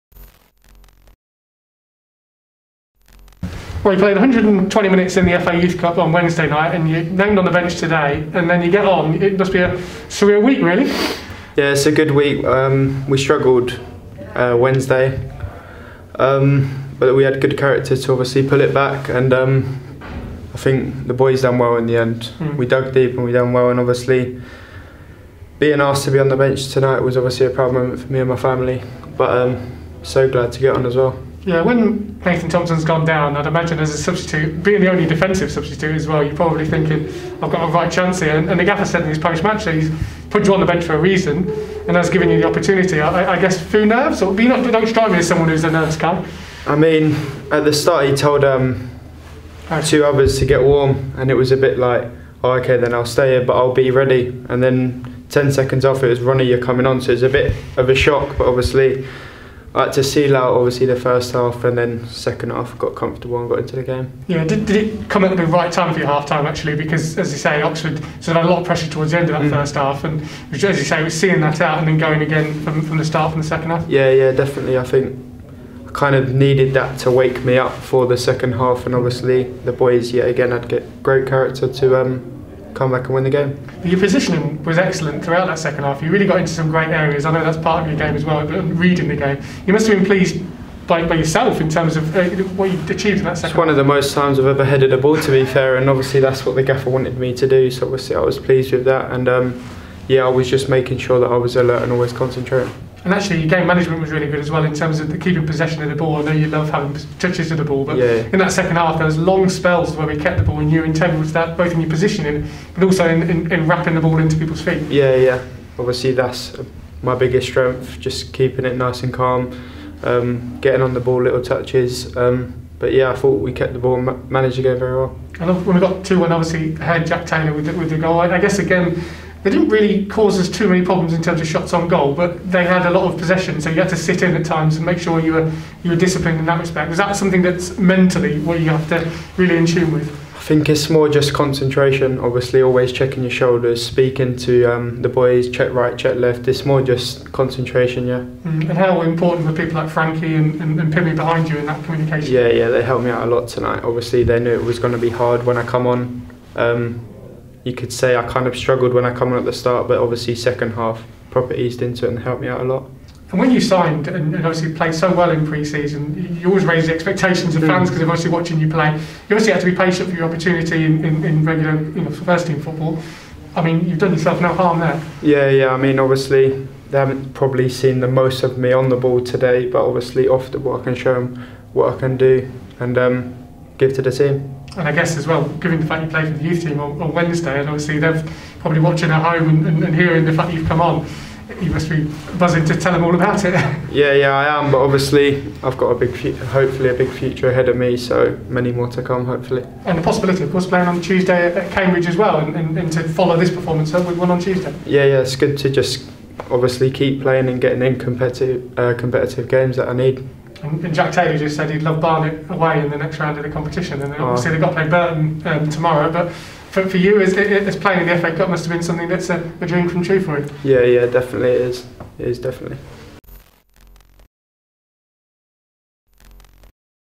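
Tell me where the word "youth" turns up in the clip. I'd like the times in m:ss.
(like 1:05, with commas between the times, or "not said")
0:05, 3:06.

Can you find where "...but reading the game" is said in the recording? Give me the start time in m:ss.
1:28.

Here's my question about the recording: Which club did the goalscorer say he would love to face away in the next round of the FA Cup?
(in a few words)
Barnet.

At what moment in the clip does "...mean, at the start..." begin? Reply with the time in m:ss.
0:46.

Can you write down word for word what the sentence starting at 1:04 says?
Yeah, did, did it come at the right time for your half time actually?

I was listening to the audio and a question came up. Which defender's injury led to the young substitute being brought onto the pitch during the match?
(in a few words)
Nathan Thompson.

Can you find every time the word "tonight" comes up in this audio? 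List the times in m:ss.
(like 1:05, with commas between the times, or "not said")
0:26, 2:33.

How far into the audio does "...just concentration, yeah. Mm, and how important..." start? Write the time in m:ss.
2:26.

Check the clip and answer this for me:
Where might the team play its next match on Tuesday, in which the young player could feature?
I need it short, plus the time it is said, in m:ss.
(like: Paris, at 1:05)
Cambridge, at 3:21.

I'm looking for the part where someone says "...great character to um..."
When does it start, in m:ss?
1:21.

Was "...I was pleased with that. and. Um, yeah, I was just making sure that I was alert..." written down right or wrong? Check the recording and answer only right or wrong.
right.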